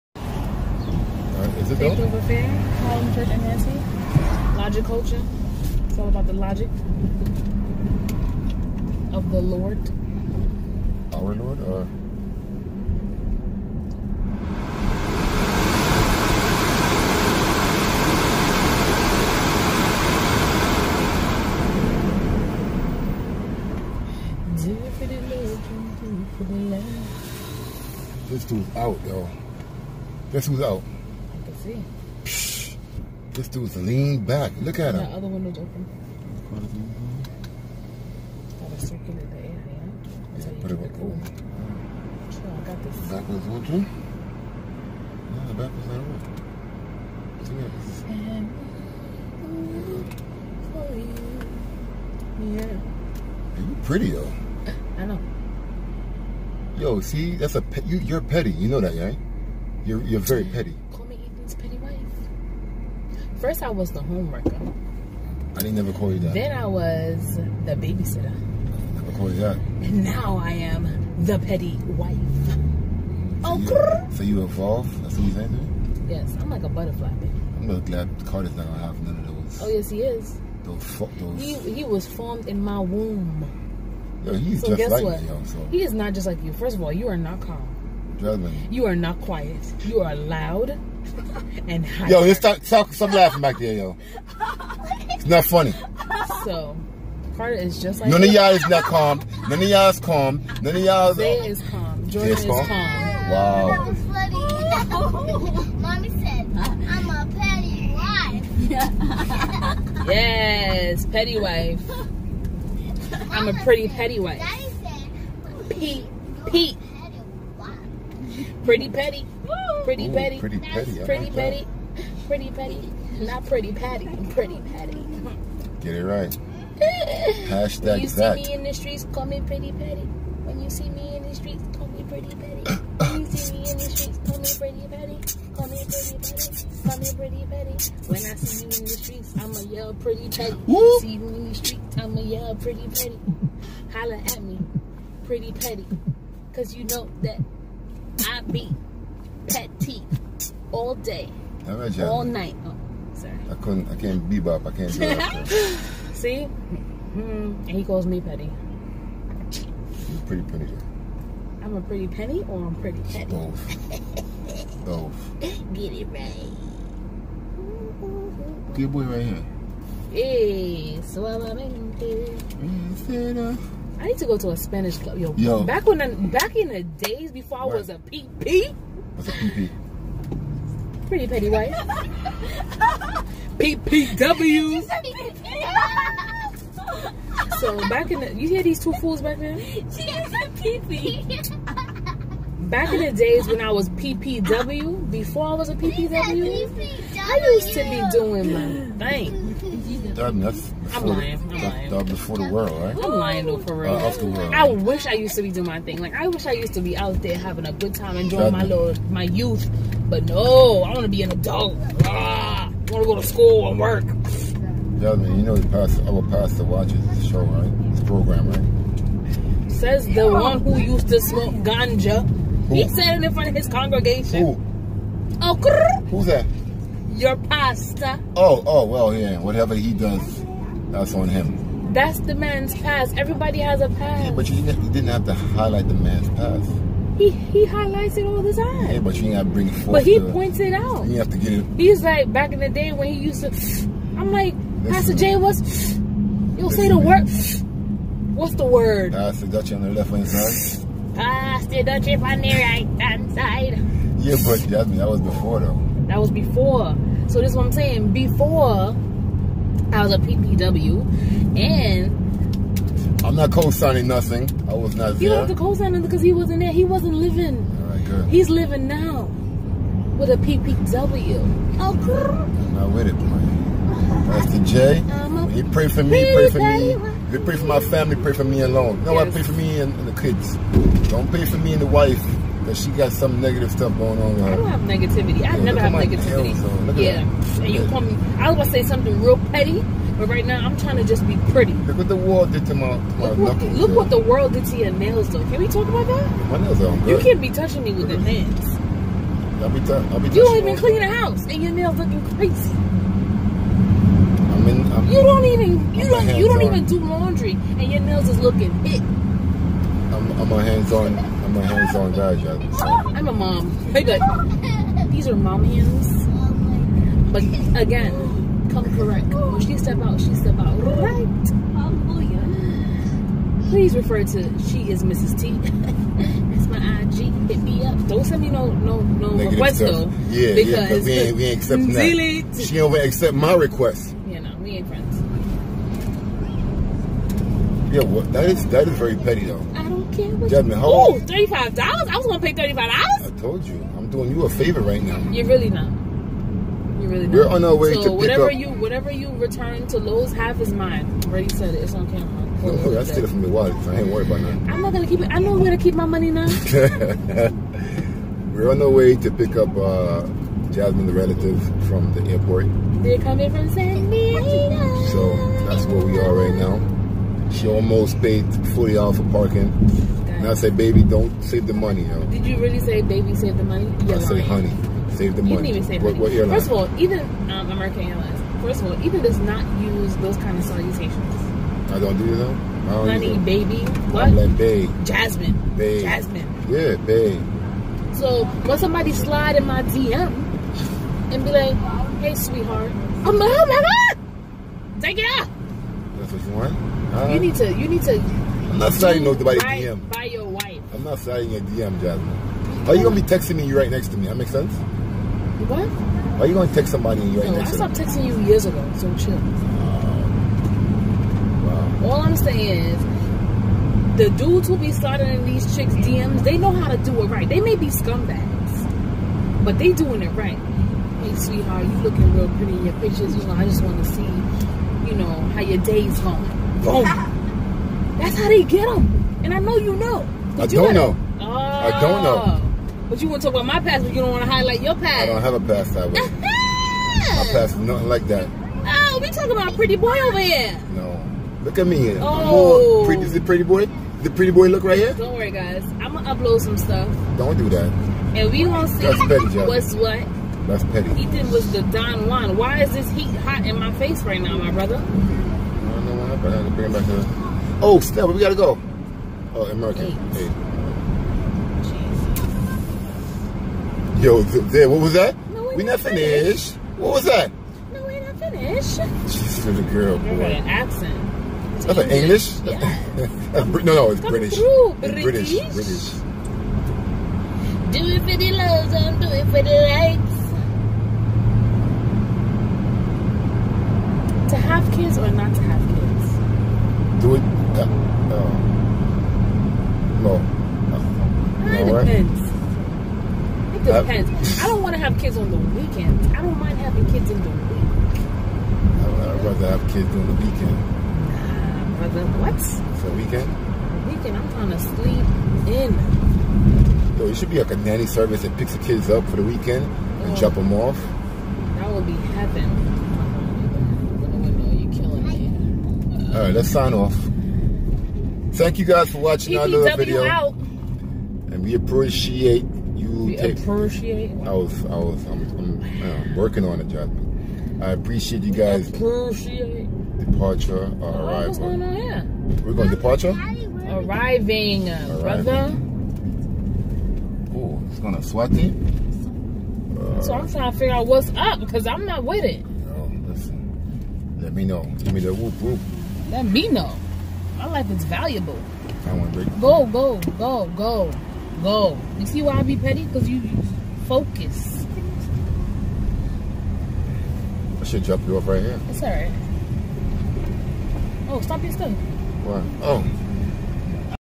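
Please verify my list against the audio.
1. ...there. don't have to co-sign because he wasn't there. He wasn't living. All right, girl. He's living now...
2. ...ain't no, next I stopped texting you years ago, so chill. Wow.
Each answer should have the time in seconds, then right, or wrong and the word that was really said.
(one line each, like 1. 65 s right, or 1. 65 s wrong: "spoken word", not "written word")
1. 265 s right
2. 407 s right.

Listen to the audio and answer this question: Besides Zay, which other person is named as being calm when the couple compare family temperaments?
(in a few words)
Jordan.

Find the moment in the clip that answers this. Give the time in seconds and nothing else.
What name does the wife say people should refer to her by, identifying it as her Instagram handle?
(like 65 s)
325 s.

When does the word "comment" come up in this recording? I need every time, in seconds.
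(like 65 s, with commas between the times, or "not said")
not said.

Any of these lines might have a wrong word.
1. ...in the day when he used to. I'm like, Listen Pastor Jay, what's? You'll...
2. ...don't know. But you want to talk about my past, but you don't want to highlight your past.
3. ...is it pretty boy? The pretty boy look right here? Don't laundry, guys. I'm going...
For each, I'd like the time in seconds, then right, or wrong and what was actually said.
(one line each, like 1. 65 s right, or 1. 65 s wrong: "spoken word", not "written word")
1. 242 s right
2. 432 s right
3. 443 s wrong: "worry", not "laundry".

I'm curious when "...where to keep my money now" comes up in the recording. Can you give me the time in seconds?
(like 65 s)
355 s.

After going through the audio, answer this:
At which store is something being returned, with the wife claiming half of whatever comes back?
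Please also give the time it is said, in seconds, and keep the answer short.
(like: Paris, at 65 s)
Lowe's, at 349 s.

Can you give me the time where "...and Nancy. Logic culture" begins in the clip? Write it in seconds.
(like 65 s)
3 s.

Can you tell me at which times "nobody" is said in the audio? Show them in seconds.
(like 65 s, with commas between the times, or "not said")
399 s.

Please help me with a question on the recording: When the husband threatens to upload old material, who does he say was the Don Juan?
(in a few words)
Ethan.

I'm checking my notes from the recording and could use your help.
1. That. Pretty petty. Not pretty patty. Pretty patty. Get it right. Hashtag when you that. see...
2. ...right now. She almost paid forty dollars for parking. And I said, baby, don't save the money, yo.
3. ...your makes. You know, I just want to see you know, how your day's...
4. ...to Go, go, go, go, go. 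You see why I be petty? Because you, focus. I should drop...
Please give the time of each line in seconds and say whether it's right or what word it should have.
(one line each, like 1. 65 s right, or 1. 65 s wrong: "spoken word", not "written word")
1. 121 s right
2. 366 s right
3. 422 s wrong: "pictures", not "makes"
4. 549 s right.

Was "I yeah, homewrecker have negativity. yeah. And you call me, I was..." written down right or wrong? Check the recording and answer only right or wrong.
wrong.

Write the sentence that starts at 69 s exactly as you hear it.
And now I am the petty wife.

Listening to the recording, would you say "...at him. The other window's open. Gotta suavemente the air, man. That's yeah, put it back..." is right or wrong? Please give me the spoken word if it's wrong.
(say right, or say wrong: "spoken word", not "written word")
wrong: "circulate", not "suavemente".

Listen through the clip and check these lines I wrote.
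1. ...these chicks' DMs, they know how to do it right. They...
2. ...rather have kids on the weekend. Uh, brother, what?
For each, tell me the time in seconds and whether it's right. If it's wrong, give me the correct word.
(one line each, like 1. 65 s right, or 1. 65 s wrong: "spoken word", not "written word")
1. 415 s right
2. 499 s right.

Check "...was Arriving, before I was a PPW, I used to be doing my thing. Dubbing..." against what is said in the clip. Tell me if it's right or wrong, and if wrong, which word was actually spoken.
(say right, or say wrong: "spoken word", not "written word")
wrong: "PPW", not "Arriving".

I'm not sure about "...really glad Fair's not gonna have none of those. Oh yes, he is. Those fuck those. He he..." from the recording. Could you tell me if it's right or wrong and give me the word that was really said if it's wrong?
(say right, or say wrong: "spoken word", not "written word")
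wrong: "Carter", not "Fair".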